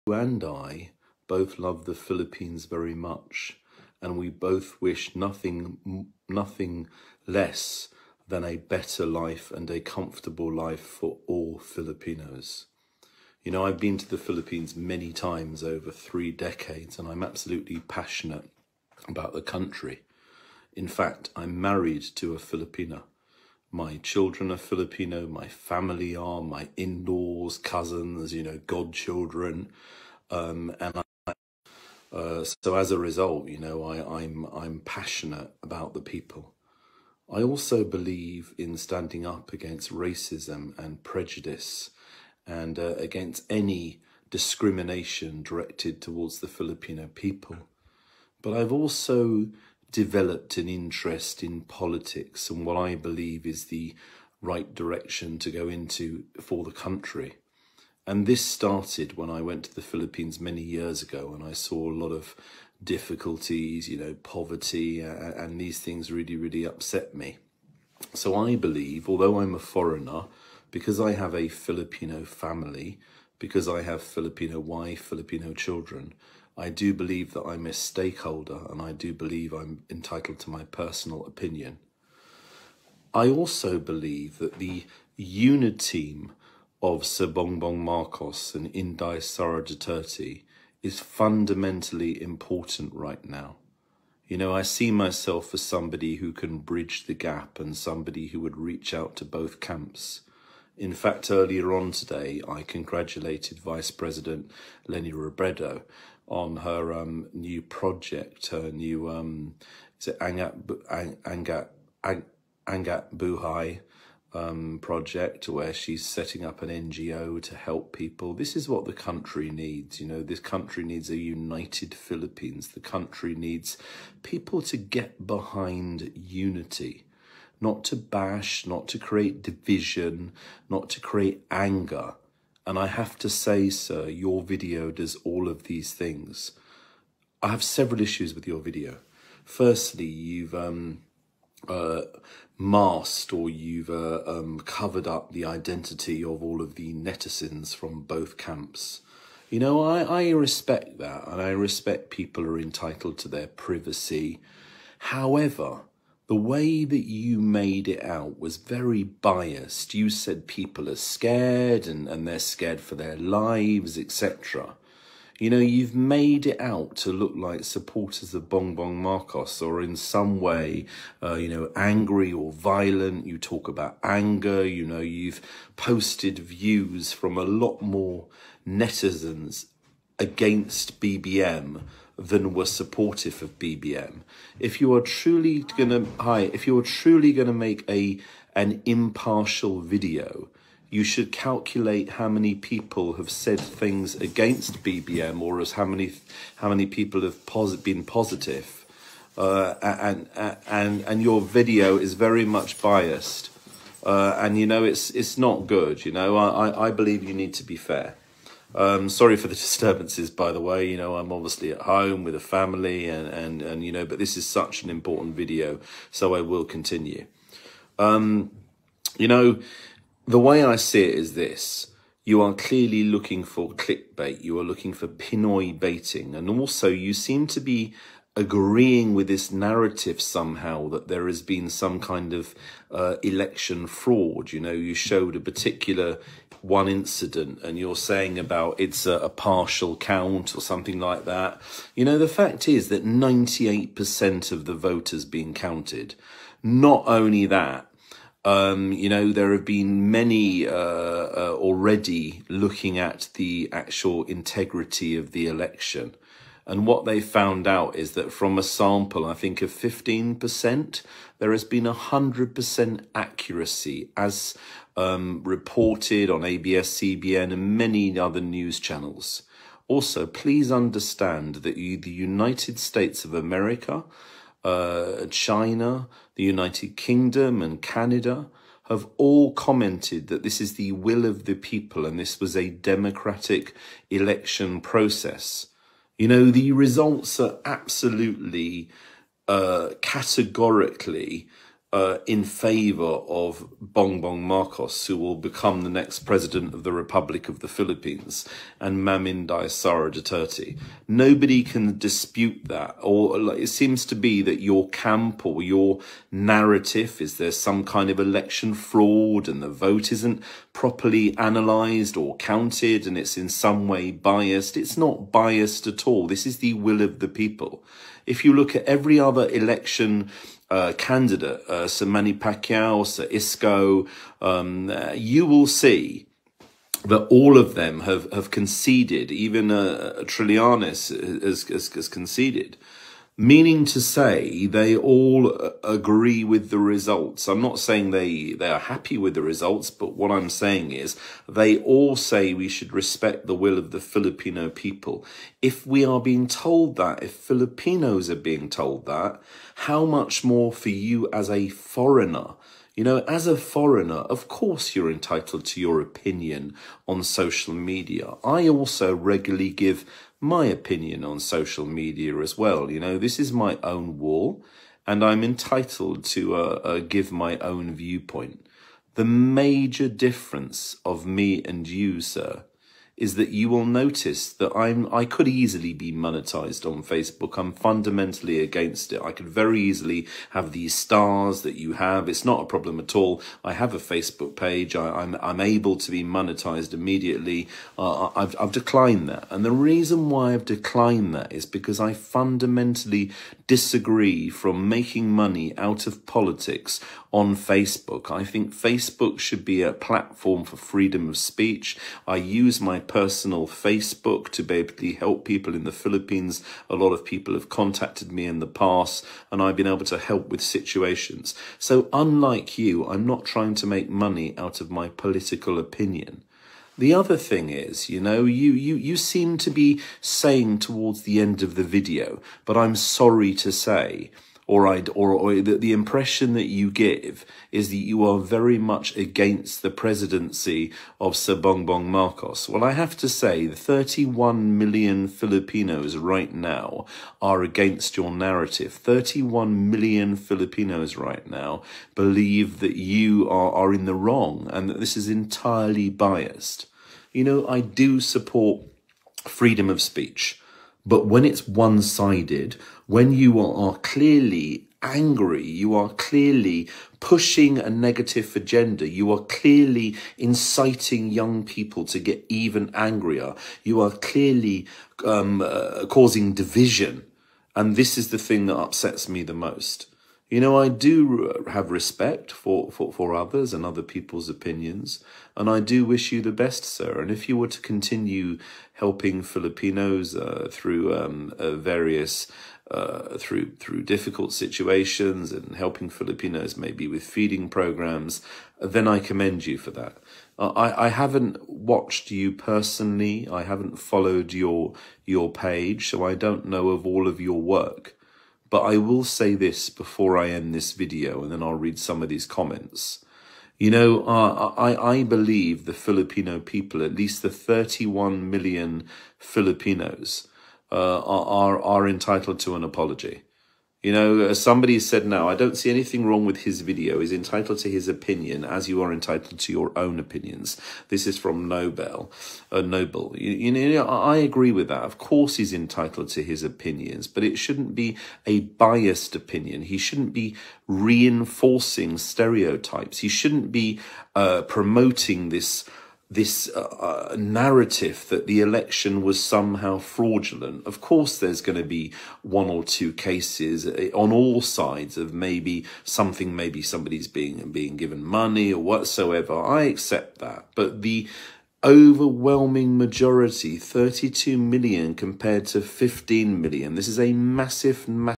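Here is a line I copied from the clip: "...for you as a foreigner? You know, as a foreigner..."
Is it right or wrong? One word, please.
right.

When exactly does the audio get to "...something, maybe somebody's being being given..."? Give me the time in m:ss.
9:06.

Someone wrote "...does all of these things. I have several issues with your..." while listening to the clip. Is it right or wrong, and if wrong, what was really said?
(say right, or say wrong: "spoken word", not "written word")
right.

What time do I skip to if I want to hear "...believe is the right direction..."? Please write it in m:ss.
0:52.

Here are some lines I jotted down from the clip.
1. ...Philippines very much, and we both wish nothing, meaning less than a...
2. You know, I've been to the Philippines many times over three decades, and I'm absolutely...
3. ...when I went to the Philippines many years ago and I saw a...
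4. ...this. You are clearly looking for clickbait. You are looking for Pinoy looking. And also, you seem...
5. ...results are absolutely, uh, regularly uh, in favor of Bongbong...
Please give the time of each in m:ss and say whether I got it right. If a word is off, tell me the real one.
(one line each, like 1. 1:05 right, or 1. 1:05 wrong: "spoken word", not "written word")
1. 0:01 wrong: "nothing", not "meaning"
2. 0:13 right
3. 0:59 right
4. 3:41 wrong: "baiting", not "looking"
5. 4:46 wrong: "categorically", not "regularly".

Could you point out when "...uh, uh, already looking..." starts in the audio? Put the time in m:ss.
4:10.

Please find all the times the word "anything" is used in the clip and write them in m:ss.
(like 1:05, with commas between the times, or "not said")
8:35.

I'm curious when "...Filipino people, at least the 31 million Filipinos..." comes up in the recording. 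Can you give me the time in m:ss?
8:25.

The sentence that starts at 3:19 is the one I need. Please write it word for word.
Uh, and and and your video is very much biased, uh, and you know it's it's not good.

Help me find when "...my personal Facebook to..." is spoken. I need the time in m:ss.
6:42.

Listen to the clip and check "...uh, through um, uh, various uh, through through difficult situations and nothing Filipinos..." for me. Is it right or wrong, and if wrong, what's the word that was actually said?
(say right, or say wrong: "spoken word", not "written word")
wrong: "helping", not "nothing".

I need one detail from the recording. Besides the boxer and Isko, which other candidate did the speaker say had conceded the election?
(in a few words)
Trillanes.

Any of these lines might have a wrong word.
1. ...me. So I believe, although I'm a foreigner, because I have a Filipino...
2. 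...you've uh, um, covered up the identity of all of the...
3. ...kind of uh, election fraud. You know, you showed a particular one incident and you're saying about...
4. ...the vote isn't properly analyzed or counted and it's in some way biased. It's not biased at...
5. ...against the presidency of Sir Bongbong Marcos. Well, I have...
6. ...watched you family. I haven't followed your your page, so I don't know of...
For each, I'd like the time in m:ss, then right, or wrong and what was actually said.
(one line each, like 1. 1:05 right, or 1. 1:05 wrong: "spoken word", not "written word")
1. 1:07 right
2. 2:23 right
3. 3:51 right
4. 5:09 right
5. 7:09 right
6. 8:11 wrong: "personally", not "family".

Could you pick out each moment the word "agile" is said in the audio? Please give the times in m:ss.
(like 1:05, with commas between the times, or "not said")
not said.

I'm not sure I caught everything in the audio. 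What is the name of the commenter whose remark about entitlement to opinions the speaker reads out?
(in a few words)
Noble.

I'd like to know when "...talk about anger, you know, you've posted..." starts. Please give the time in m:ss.
2:53.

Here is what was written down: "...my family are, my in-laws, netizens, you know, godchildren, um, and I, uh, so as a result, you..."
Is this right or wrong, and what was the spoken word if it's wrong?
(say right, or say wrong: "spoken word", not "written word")
wrong: "cousins", not "netizens".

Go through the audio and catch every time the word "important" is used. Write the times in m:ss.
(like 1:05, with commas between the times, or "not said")
1:32, 3:34.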